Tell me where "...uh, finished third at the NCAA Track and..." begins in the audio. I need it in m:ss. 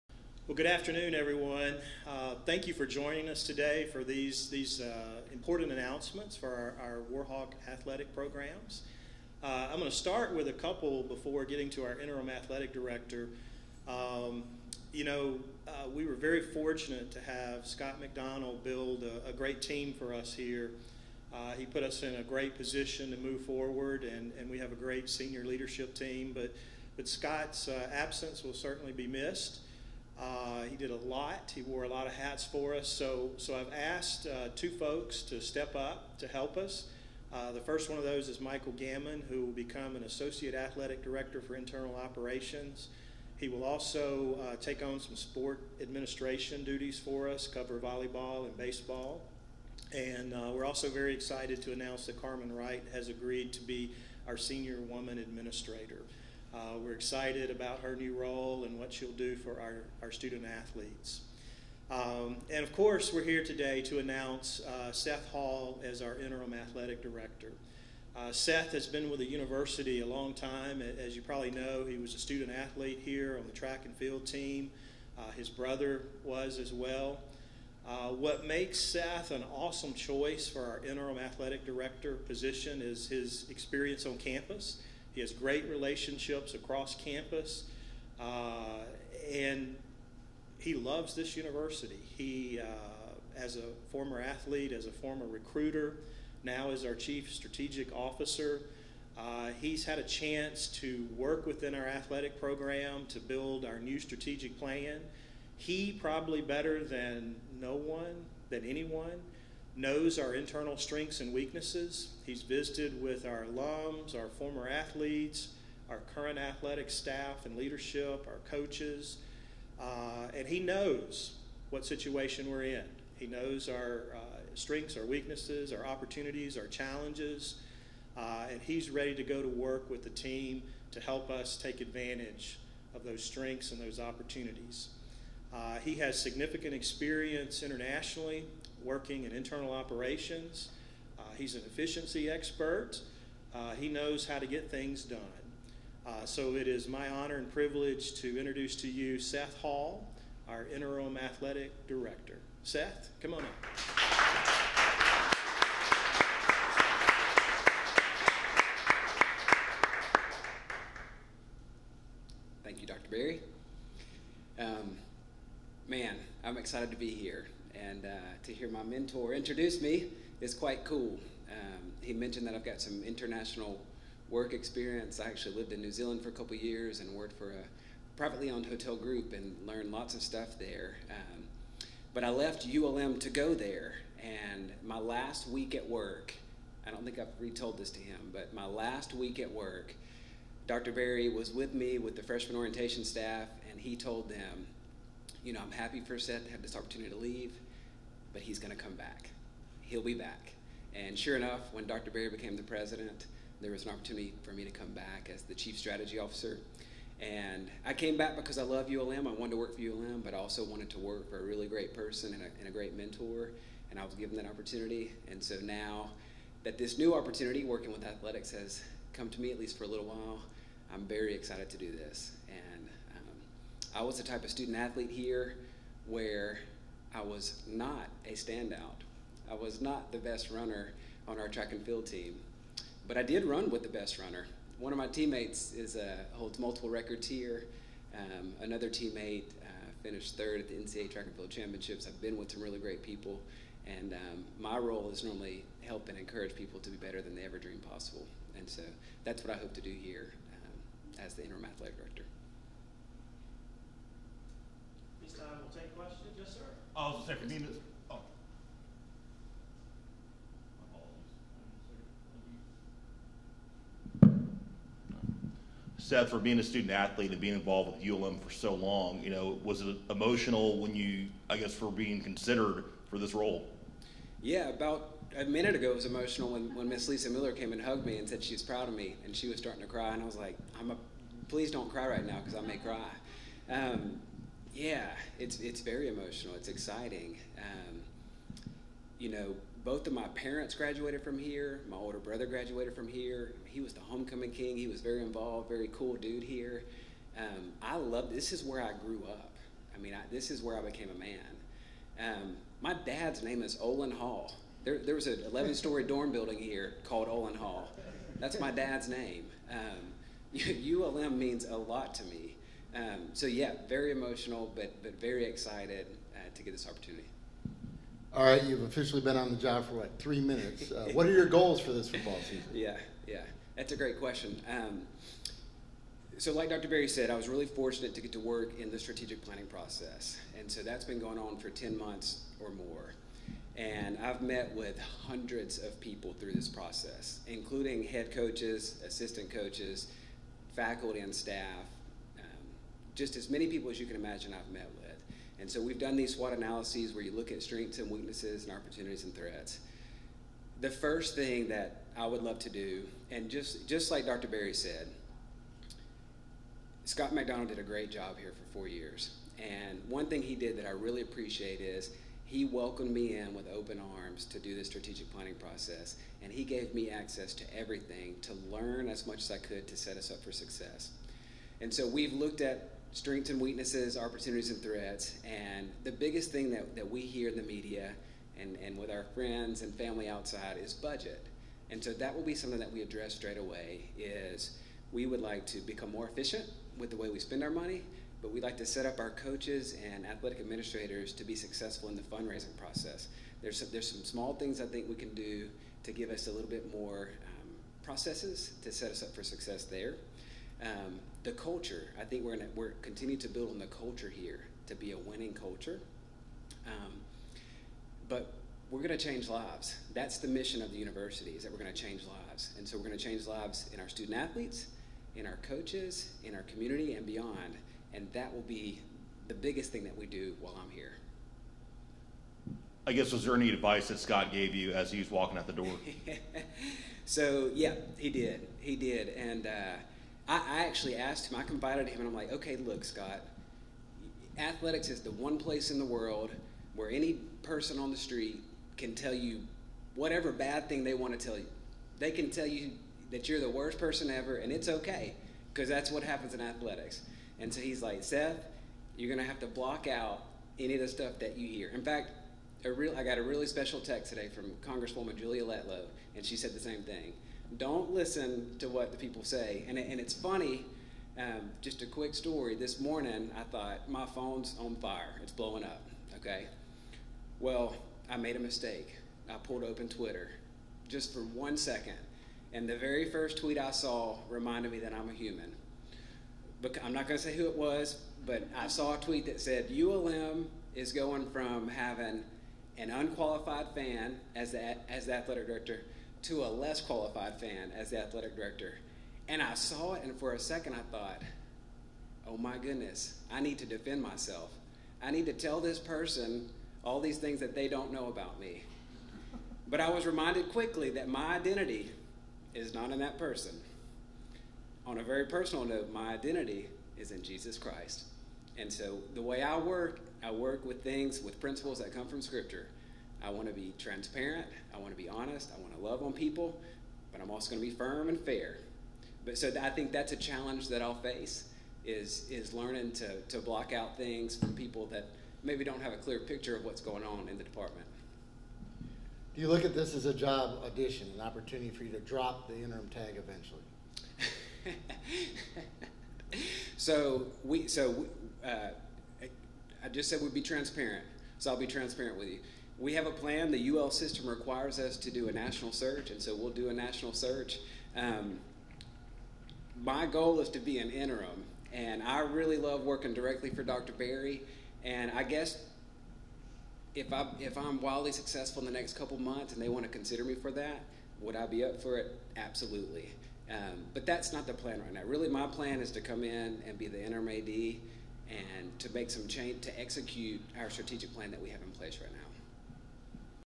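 3:59.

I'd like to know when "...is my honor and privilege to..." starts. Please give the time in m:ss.
2:26.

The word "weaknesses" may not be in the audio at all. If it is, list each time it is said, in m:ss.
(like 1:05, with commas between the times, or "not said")
1:51, 2:05, 5:48, 6:13.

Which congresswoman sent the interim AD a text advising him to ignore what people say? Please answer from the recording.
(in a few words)
Julia Letlow.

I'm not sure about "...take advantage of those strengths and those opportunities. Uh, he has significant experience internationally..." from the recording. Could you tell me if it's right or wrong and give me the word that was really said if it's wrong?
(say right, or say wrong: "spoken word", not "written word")
right.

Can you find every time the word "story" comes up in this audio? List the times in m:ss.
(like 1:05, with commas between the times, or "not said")
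5:05, 7:42.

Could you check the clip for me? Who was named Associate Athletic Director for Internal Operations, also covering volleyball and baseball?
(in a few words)
Michael Gammon.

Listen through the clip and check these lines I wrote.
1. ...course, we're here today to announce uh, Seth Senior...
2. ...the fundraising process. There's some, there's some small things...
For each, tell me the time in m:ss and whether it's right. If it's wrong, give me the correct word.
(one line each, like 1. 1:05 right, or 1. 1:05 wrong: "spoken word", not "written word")
1. 1:02 wrong: "Hall", not "Senior"
2. 6:32 right.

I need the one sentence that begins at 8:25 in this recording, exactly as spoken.
On a very personal note, my identity is in Jesus Christ.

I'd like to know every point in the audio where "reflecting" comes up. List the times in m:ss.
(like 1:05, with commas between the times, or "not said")
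not said.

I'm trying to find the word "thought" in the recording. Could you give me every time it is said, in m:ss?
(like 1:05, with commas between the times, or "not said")
7:43, 8:11.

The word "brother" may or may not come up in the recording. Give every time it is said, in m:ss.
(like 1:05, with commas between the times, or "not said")
1:15, 4:52.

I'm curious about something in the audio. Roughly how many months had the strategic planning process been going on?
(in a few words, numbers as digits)
10.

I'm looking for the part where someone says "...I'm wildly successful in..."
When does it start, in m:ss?
9:17.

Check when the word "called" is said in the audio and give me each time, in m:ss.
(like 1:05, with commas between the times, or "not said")
5:07.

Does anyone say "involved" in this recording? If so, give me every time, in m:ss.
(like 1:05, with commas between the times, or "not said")
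4:27, 4:55.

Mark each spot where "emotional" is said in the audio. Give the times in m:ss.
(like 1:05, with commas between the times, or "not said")
4:30, 4:36, 4:46, 5:14.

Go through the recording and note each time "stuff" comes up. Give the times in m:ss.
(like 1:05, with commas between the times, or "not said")
3:00, 7:31.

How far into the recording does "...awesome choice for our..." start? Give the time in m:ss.
1:19.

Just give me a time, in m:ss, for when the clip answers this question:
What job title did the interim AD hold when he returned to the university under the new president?
3:25.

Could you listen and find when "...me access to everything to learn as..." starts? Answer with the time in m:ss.
6:06.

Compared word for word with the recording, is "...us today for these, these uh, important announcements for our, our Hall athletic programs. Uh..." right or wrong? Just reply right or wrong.
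wrong.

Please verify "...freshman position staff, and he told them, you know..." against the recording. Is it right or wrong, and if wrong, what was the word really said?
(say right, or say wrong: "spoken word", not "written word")
wrong: "orientation", not "position".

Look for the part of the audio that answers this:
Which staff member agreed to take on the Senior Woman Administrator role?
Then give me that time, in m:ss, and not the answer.
0:52.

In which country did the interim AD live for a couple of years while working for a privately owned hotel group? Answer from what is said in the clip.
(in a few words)
New Zealand.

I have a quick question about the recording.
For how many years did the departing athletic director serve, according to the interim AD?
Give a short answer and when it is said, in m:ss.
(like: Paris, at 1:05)
4, at 5:58.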